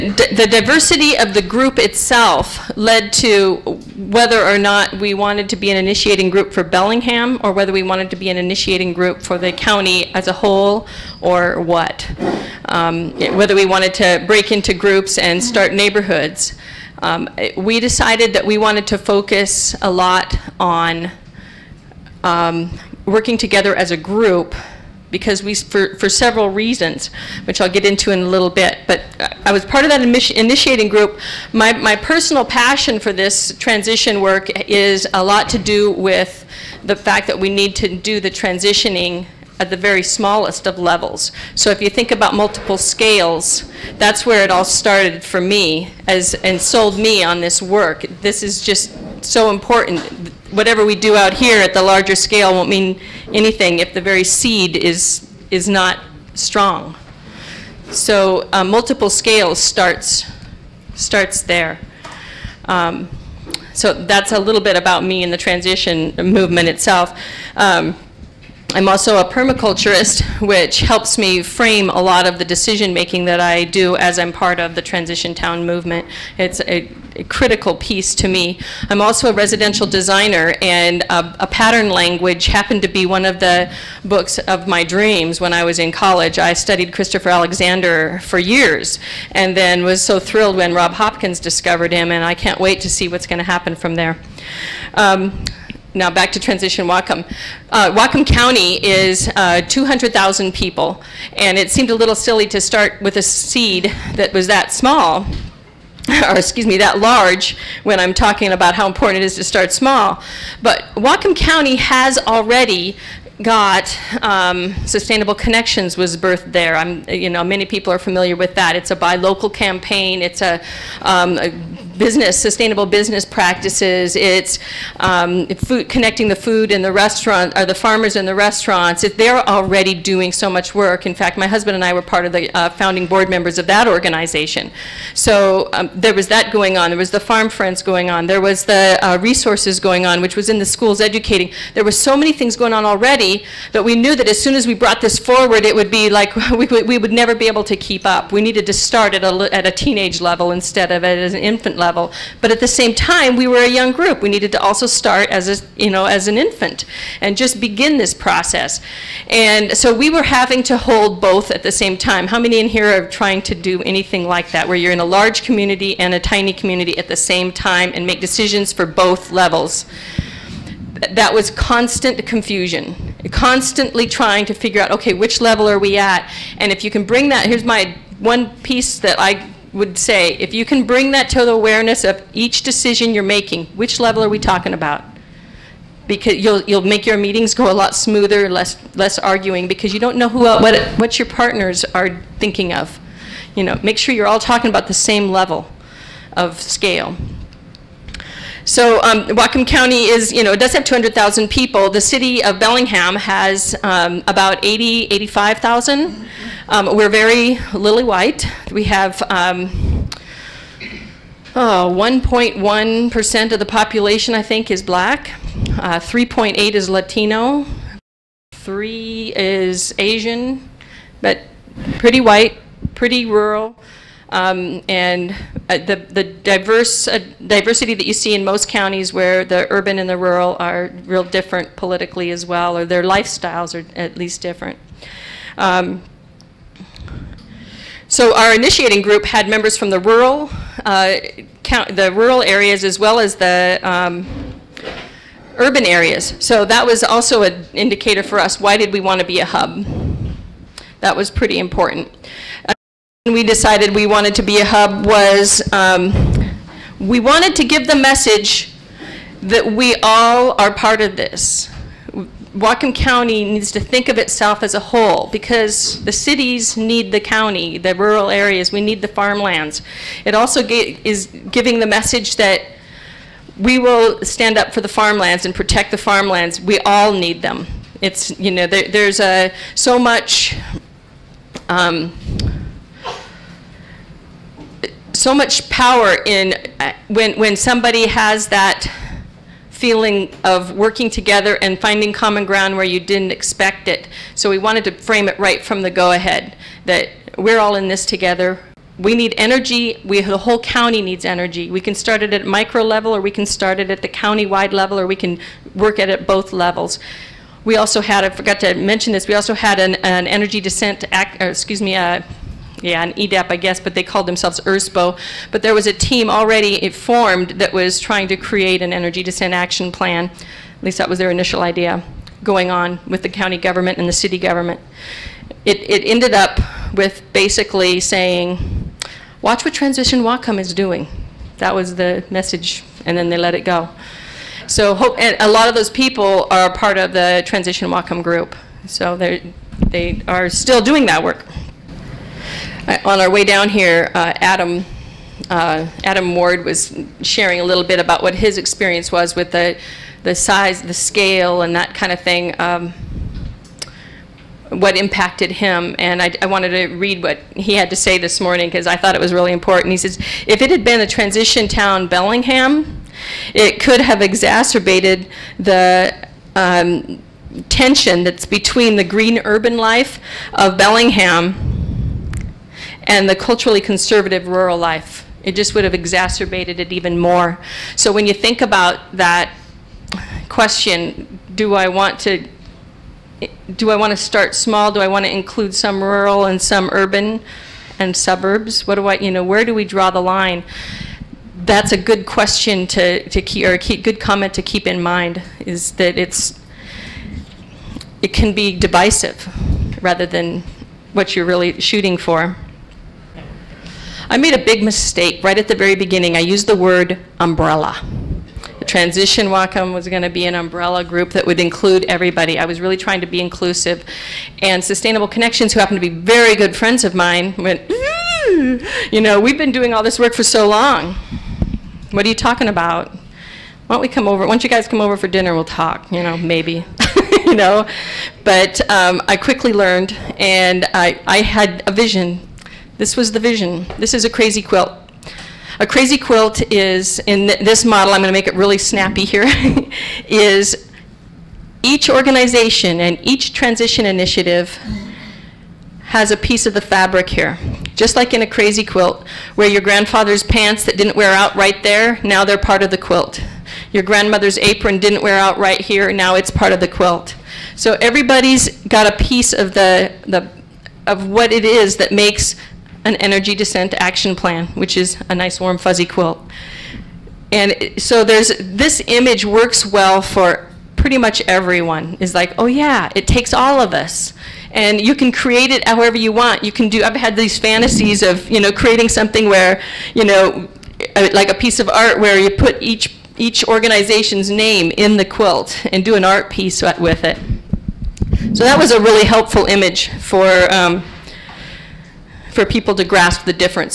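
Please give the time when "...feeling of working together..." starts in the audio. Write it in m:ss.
4:49.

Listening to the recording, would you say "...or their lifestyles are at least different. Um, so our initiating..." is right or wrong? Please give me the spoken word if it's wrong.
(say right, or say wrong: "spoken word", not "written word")
right.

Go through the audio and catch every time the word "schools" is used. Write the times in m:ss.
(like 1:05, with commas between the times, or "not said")
2:20.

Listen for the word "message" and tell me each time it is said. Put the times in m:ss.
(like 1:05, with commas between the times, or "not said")
4:17, 4:31, 5:32.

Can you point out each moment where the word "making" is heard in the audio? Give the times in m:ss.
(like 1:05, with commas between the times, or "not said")
1:12, 3:03.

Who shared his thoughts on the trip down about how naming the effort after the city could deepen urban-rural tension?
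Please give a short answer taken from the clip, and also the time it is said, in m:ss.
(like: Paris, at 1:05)
Adam Ward, at 5:46.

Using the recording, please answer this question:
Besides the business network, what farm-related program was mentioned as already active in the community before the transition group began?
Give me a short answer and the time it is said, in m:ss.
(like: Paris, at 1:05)
Farm Friends, at 2:17.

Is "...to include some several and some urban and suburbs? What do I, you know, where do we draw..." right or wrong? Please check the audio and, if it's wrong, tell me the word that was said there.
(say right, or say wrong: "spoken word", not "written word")
wrong: "rural", not "several".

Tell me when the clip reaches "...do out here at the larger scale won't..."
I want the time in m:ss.
0:50.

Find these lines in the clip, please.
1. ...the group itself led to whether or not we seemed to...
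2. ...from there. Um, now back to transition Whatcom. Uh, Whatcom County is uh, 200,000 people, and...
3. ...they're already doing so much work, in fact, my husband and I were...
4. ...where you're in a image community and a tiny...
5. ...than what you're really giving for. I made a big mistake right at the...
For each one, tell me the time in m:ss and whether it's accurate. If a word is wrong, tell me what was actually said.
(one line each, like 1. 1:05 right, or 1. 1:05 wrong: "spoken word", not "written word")
1. 0:01 wrong: "wanted", not "seemed"
2. 1:33 right
3. 2:09 right
4. 2:44 wrong: "large", not "image"
5. 6:40 wrong: "shooting", not "giving".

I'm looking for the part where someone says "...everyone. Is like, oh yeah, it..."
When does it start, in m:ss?
7:51.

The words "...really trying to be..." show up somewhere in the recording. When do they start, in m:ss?
6:52.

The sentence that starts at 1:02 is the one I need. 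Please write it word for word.
Um, so that's a little bit about me and the transition movement itself.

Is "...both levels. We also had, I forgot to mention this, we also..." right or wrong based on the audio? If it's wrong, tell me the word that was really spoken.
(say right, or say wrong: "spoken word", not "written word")
right.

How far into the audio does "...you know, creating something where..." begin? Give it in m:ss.
7:58.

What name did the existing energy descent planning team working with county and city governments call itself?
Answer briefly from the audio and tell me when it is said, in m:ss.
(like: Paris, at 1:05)
ERSPO, at 5:14.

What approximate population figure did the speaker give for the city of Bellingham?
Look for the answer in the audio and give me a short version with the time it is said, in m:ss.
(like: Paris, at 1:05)
80,000 to 85,000, at 3:24.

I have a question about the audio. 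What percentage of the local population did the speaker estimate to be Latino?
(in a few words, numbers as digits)
3.8%.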